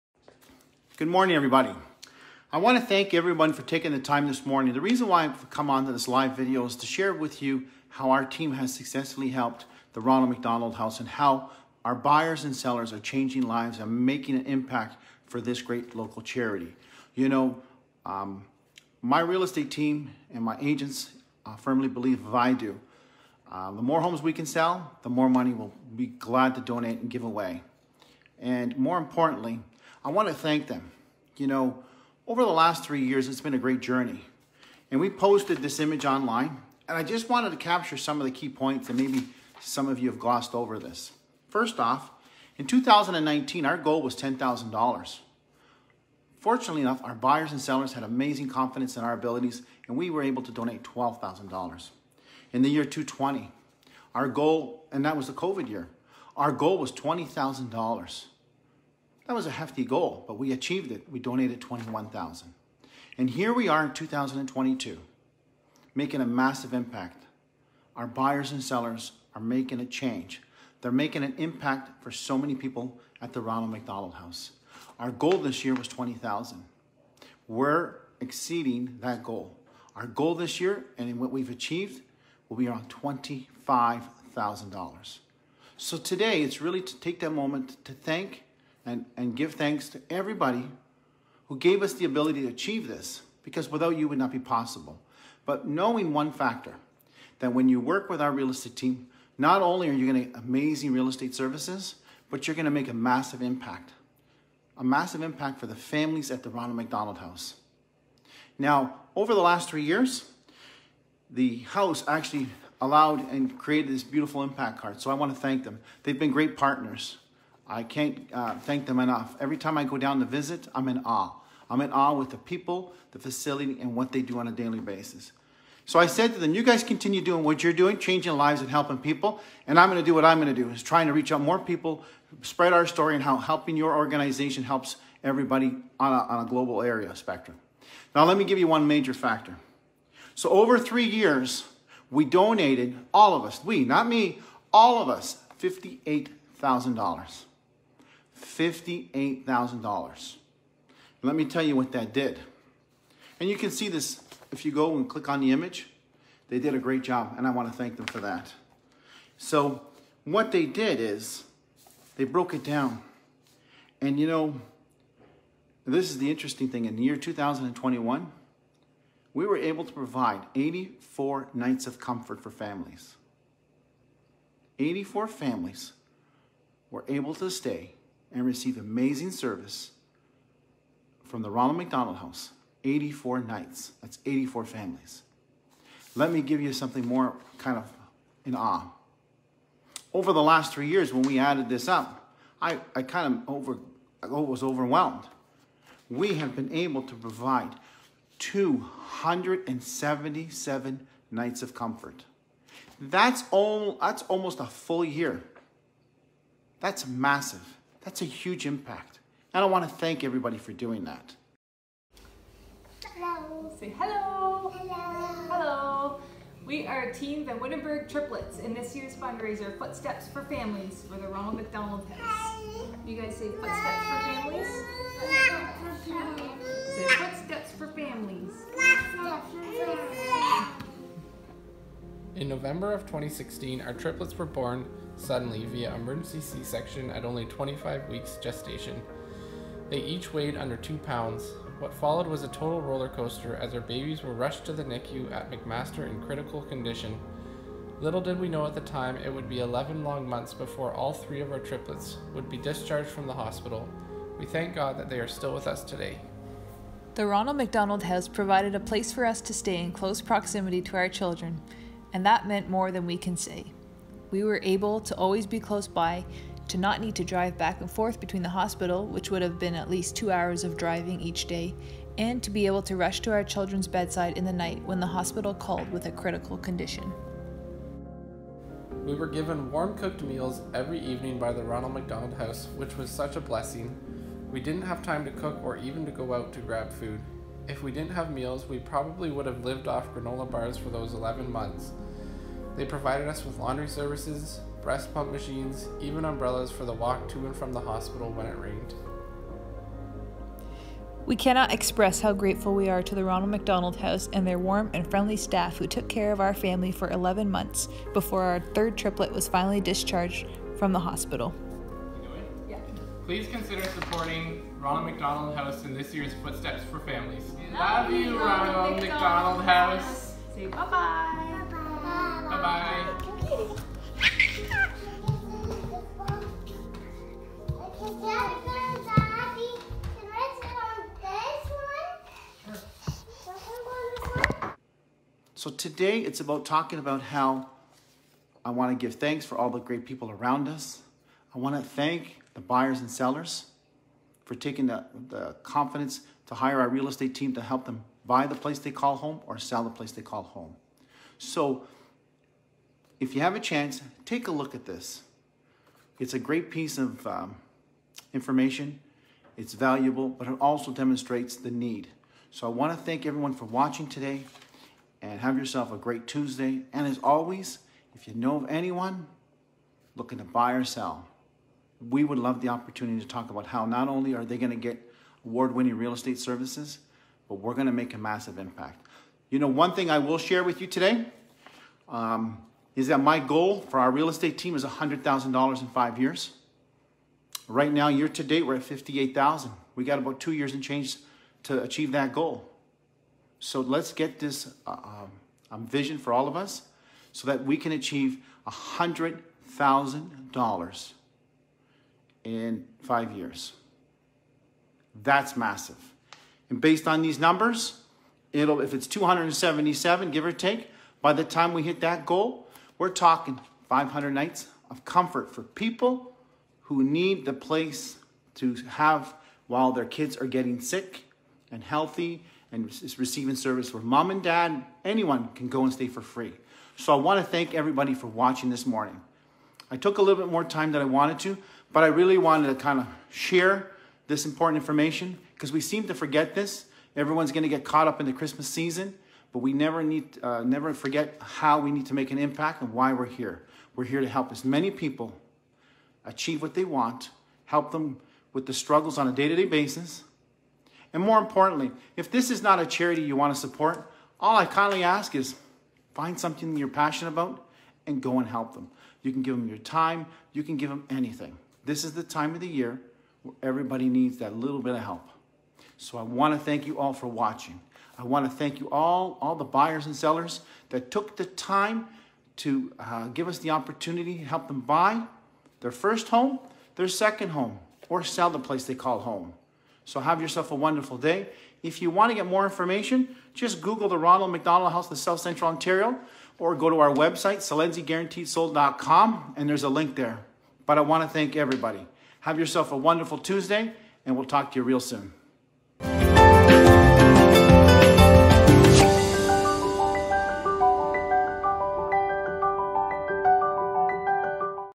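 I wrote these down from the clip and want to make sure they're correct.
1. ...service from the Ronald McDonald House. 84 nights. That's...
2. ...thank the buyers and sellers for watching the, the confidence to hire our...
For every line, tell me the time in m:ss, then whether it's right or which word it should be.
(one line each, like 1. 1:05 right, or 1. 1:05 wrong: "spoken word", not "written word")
1. 2:59 right
2. 5:41 wrong: "taking", not "watching".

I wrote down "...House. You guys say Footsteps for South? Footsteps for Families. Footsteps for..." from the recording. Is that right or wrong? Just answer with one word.
wrong.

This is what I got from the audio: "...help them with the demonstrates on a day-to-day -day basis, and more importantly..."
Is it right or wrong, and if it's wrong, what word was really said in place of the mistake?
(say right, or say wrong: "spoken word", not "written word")
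wrong: "struggles", not "demonstrates".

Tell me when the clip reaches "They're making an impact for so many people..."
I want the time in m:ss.
1:10.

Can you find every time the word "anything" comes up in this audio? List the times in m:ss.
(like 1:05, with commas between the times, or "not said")
7:41.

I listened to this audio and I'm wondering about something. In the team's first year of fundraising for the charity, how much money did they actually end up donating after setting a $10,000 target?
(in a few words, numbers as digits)
$12,000.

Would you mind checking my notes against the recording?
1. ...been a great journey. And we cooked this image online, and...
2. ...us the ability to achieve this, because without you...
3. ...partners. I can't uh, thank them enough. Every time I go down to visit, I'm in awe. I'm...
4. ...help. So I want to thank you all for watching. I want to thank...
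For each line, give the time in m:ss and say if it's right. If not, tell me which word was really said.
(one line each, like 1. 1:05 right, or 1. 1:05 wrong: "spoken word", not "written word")
1. 0:33 wrong: "posted", not "cooked"
2. 1:31 right
3. 1:56 right
4. 7:45 right.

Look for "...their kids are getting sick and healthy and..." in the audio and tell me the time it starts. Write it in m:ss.
6:59.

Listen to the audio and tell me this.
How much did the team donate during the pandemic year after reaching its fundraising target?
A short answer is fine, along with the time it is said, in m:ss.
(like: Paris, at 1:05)
21,000, at 1:01.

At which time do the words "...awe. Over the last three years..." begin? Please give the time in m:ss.
3:08.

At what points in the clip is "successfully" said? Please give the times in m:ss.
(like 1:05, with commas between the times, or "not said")
0:08.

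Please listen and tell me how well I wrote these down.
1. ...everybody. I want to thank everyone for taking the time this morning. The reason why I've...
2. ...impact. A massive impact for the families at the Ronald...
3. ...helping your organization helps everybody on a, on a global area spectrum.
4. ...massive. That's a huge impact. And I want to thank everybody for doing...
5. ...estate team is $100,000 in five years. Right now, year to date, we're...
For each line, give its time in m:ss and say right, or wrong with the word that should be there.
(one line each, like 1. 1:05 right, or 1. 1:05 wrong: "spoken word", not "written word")
1. 0:01 right
2. 1:43 right
3. 2:13 right
4. 3:27 right
5. 6:24 right.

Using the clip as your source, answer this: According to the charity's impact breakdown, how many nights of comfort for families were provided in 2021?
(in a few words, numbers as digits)
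84.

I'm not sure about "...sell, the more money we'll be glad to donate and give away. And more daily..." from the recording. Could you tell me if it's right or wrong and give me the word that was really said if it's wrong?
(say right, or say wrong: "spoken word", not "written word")
wrong: "importantly", not "daily".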